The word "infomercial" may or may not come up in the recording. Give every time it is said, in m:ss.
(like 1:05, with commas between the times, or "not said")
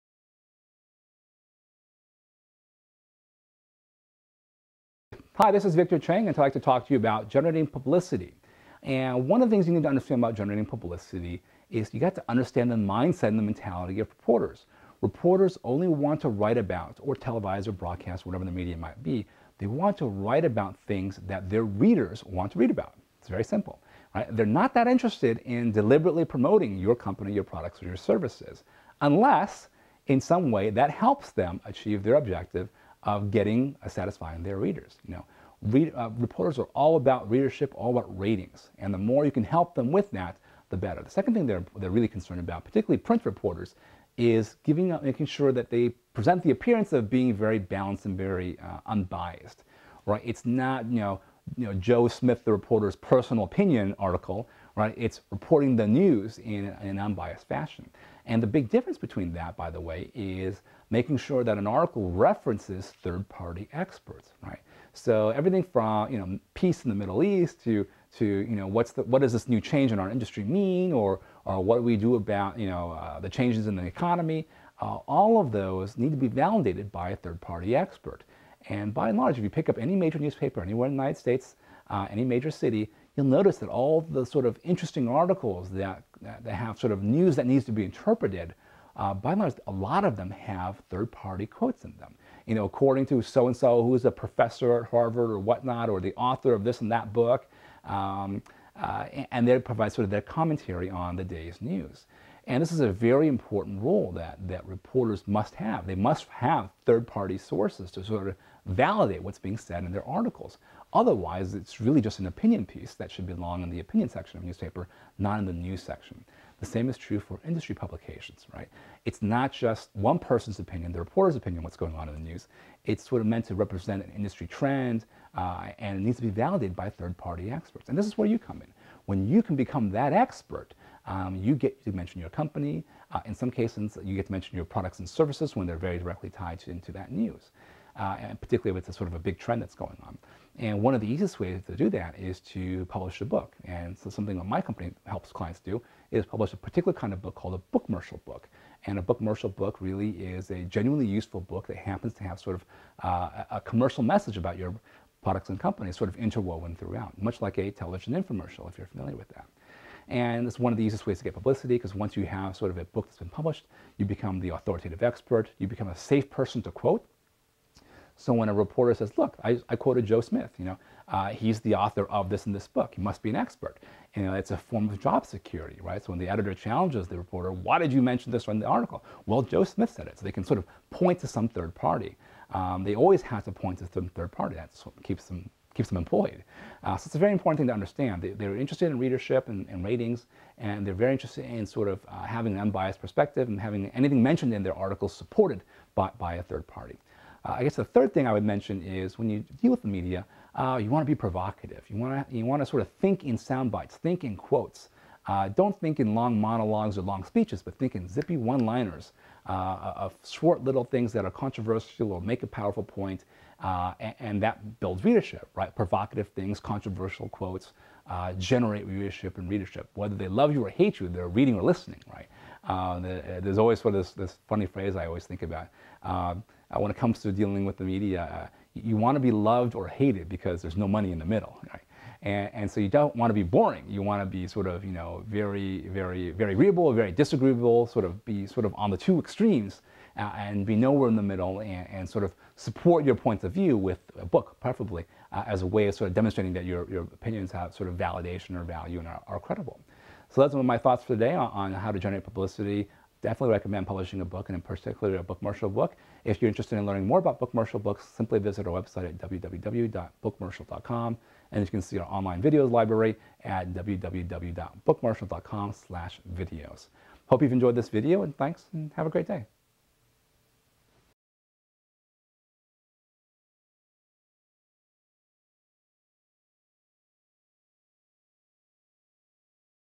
2:38.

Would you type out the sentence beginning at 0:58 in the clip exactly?
And the big difference between that, by the way, is making sure that an article references third-party experts, right?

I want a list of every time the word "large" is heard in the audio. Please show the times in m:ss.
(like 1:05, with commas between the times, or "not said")
1:19, 1:29.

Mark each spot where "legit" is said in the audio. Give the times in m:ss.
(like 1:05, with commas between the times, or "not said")
not said.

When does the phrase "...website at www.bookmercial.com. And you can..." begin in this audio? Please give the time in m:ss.
4:18.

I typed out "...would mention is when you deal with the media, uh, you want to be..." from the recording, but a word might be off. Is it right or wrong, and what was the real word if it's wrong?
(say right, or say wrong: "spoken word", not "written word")
right.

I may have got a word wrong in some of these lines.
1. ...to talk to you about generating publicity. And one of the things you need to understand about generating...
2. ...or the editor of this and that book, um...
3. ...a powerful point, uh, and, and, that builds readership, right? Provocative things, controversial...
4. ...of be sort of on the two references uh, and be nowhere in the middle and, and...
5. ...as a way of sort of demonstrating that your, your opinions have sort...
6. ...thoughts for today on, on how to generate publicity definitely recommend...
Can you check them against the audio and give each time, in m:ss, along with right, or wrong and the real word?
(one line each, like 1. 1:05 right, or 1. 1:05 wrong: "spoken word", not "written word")
1. 0:06 right
2. 1:35 wrong: "author", not "editor"
3. 3:32 right
4. 3:58 wrong: "extremes", not "references"
5. 4:05 right
6. 4:10 right.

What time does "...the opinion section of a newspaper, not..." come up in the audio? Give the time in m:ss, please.
1:53.